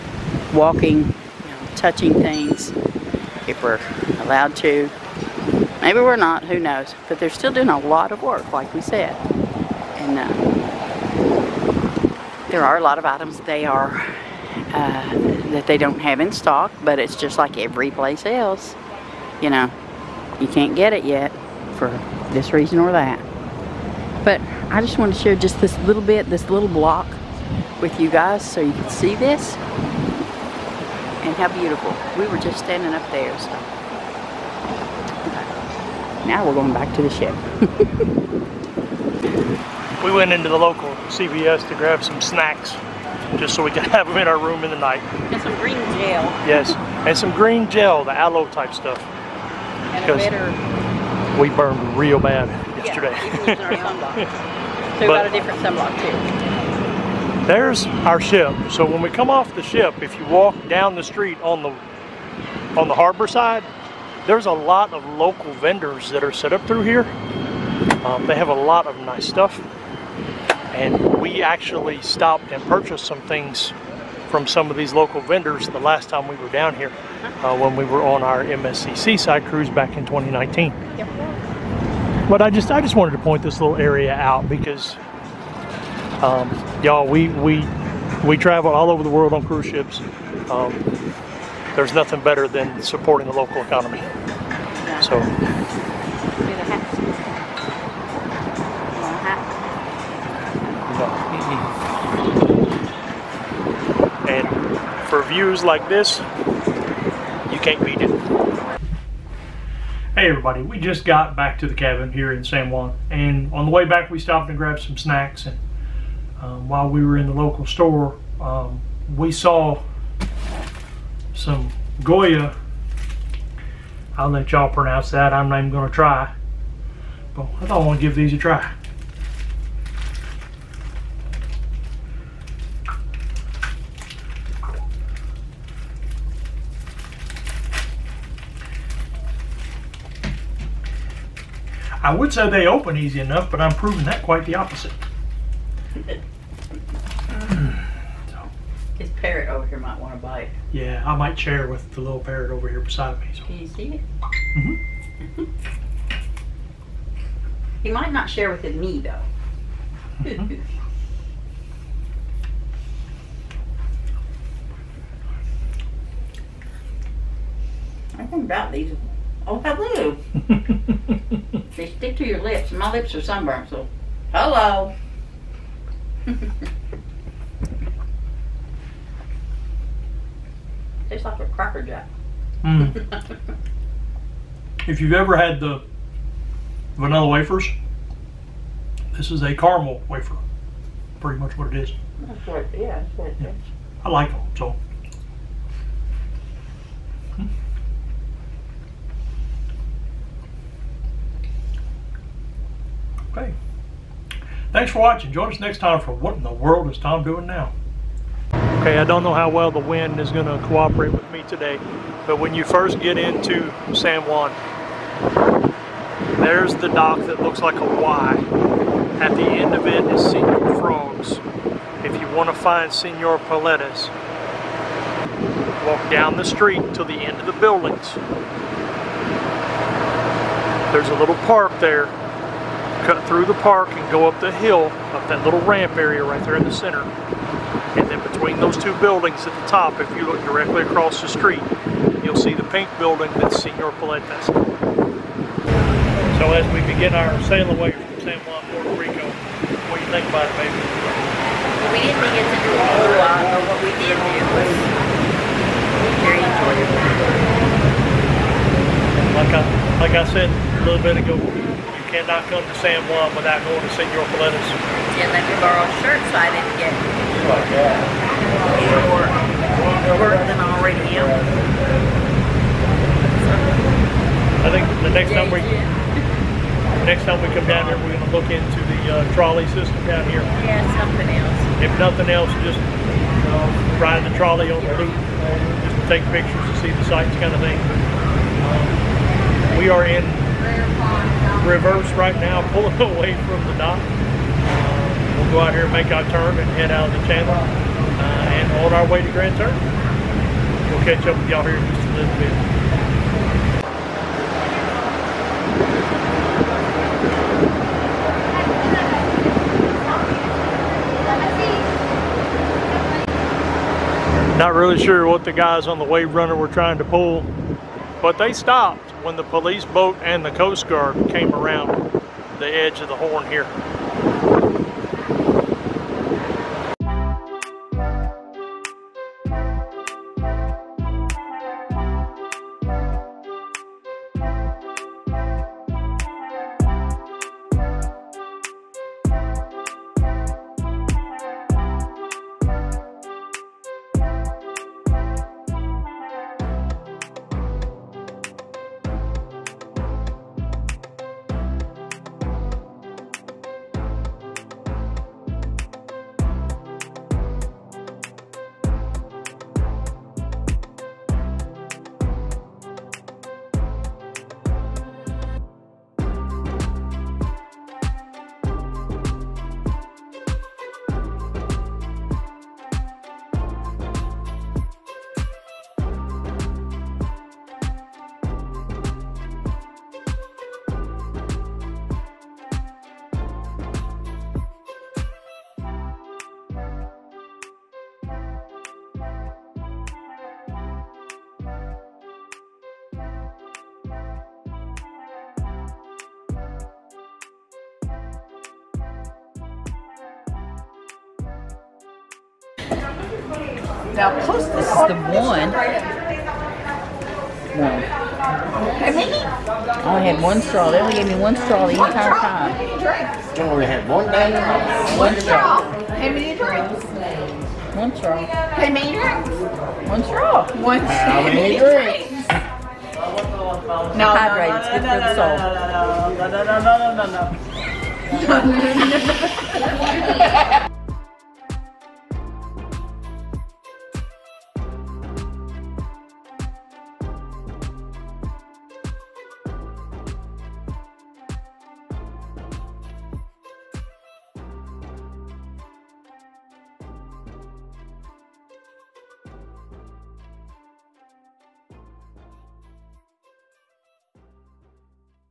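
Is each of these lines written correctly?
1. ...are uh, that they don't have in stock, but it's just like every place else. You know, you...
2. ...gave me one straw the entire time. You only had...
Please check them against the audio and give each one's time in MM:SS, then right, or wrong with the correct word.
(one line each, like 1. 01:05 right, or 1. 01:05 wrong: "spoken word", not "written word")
1. 00:13 right
2. 06:51 right.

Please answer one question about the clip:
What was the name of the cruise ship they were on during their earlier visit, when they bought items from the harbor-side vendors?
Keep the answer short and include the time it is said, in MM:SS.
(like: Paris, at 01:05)
MSC Seaside, at 01:18.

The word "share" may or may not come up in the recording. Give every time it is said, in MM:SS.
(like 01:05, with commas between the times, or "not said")
00:25, 02:31, 02:38.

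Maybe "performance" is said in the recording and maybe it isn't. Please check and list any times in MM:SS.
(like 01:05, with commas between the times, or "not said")
not said.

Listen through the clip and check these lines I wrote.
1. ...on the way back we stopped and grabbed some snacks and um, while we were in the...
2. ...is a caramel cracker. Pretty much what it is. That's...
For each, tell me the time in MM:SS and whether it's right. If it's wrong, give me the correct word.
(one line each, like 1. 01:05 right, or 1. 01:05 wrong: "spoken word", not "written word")
1. 01:53 right
2. 03:09 wrong: "wafer", not "cracker".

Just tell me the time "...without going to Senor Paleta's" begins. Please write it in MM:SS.
04:23.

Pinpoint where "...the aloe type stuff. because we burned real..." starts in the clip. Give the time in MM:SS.
00:48.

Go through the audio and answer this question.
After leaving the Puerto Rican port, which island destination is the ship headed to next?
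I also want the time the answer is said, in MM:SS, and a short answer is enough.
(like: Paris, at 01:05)
Grand Turk, at 04:59.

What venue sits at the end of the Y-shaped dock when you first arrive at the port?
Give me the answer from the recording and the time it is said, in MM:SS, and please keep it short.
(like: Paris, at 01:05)
Senor Frogs, at 03:40.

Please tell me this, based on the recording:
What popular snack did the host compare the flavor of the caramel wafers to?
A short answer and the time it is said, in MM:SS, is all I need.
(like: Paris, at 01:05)
Cracker Jack, at 03:01.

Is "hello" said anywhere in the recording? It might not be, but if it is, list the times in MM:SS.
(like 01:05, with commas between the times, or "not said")
02:49, 02:54.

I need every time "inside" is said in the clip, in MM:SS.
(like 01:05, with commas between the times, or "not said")
not said.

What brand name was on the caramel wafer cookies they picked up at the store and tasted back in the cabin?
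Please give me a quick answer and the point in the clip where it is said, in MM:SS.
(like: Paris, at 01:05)
Goya, at 02:02.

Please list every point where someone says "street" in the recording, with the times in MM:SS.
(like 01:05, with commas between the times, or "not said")
01:01, 03:46, 04:01.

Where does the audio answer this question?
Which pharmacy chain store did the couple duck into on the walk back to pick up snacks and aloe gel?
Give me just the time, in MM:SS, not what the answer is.
00:41.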